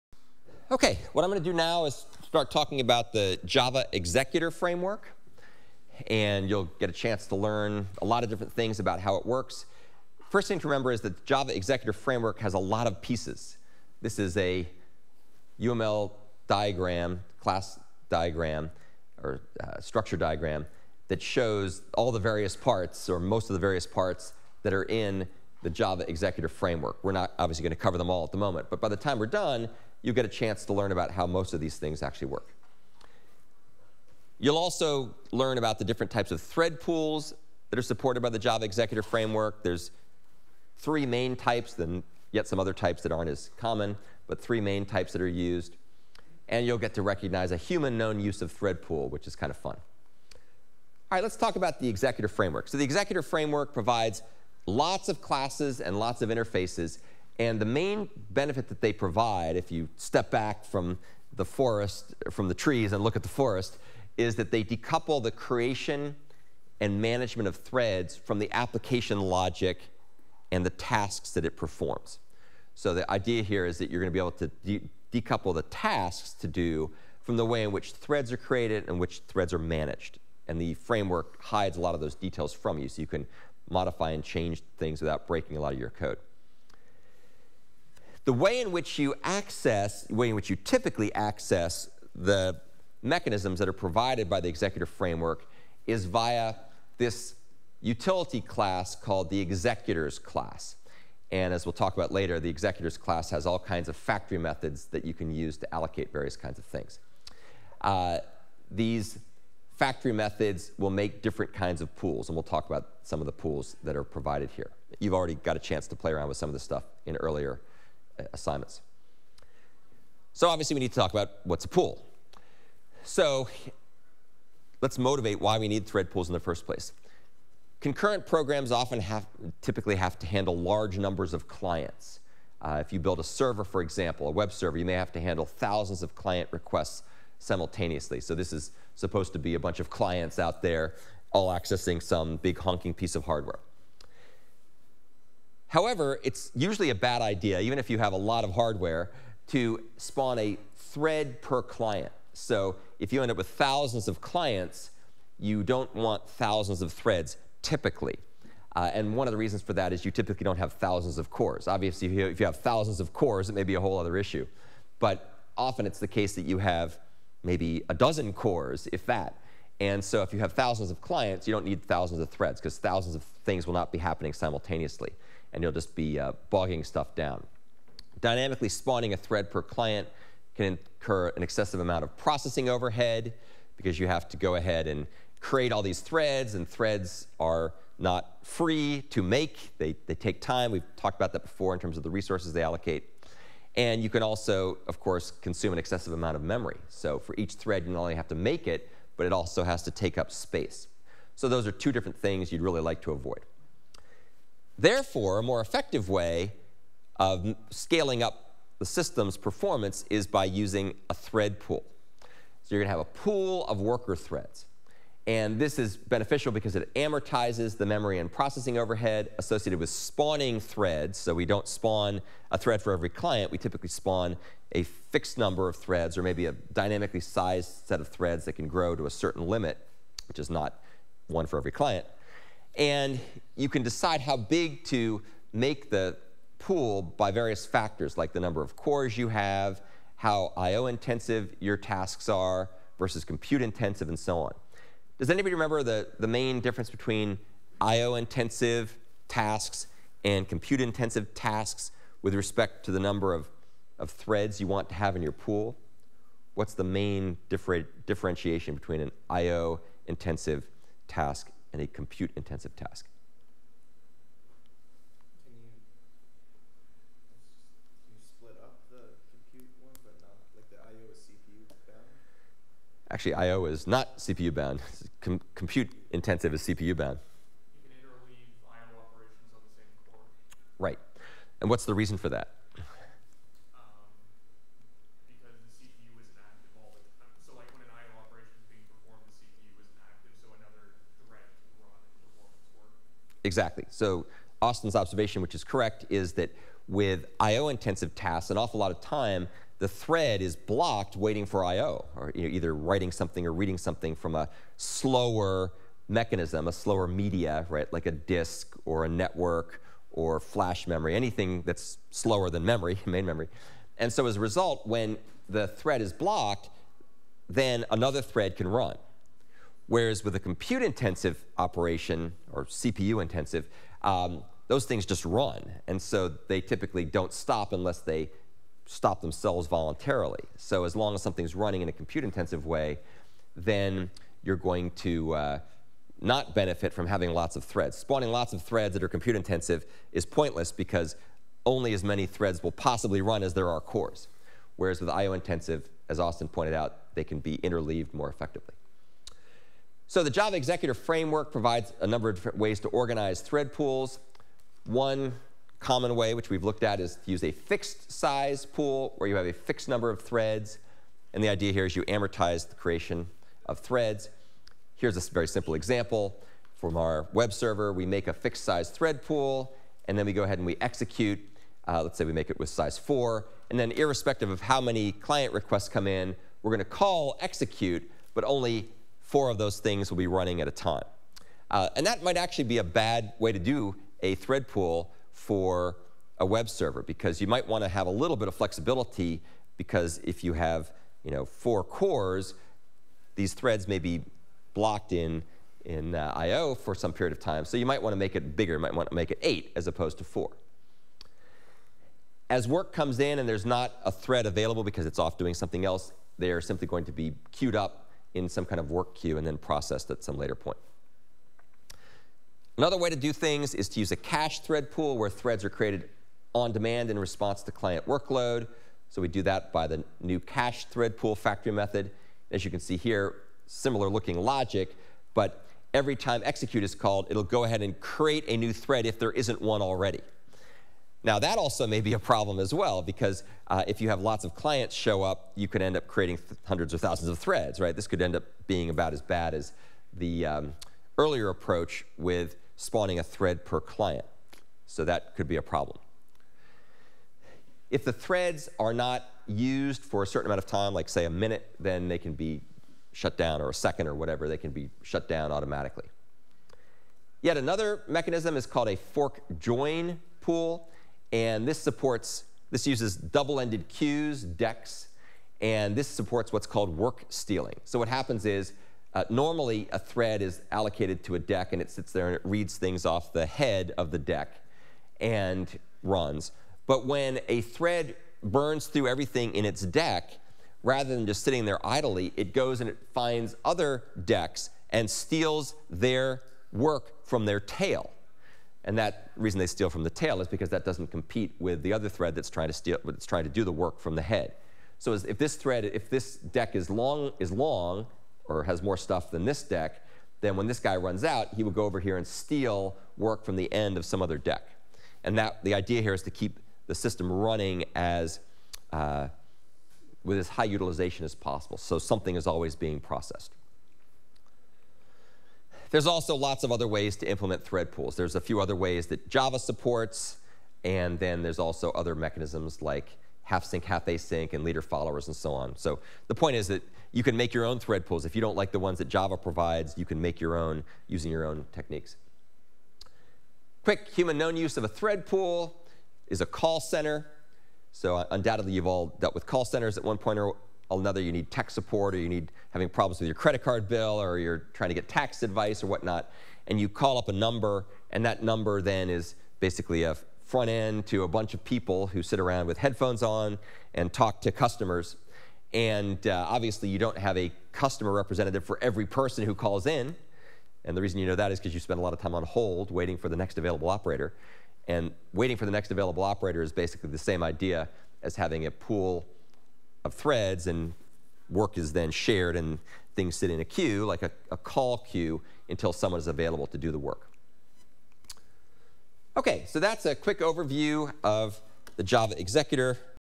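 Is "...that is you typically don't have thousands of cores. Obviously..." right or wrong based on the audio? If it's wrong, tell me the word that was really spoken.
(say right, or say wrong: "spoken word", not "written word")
right.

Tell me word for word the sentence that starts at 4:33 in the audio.
Actually, I/O is not CPU bound.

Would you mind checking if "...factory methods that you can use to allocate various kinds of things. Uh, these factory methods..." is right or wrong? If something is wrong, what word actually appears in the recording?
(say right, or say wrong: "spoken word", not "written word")
right.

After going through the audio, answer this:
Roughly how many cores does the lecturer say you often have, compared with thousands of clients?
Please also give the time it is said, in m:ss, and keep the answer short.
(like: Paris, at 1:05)
a dozen, at 2:47.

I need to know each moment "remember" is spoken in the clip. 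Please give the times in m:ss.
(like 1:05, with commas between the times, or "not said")
0:10, 4:05.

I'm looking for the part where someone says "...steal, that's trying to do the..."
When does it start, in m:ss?
8:12.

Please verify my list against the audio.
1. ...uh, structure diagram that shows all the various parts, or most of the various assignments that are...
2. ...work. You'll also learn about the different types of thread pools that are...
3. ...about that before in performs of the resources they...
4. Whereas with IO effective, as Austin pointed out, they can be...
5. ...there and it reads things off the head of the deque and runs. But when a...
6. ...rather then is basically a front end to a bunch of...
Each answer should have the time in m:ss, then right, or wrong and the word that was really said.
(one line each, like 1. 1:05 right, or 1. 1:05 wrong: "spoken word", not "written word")
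1. 0:19 wrong: "parts", not "assignments"
2. 0:32 right
3. 3:11 wrong: "terms", not "performs"
4. 5:44 wrong: "intensive", not "effective"
5. 7:52 right
6. 9:08 wrong: "number", not "rather".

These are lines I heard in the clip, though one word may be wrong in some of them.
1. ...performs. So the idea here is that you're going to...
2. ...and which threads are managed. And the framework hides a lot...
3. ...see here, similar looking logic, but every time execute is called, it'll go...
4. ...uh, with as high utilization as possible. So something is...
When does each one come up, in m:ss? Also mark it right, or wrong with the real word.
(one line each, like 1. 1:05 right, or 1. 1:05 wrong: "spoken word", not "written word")
1. 1:11 right
2. 1:18 right
3. 7:02 right
4. 8:28 right.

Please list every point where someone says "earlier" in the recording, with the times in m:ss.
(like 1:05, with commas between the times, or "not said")
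1:57, 7:21.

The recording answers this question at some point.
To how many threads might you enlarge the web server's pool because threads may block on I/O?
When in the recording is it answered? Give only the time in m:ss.
6:39.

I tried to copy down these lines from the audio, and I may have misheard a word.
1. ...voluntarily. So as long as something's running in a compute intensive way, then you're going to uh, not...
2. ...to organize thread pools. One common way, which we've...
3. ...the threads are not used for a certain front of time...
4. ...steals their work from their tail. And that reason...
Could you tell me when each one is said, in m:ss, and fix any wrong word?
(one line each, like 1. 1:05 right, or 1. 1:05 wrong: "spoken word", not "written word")
1. 5:29 right
2. 5:52 right
3. 7:28 wrong: "amount", not "front"
4. 8:05 right.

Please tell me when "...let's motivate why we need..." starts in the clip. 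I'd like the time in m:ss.
2:04.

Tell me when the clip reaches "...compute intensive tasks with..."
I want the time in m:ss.
4:10.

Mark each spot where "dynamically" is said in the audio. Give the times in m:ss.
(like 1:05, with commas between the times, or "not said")
2:58, 3:46.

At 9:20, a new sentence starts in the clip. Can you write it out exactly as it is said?
And the reason you know that is because you spend a lot of time on hold waiting for the next available operator.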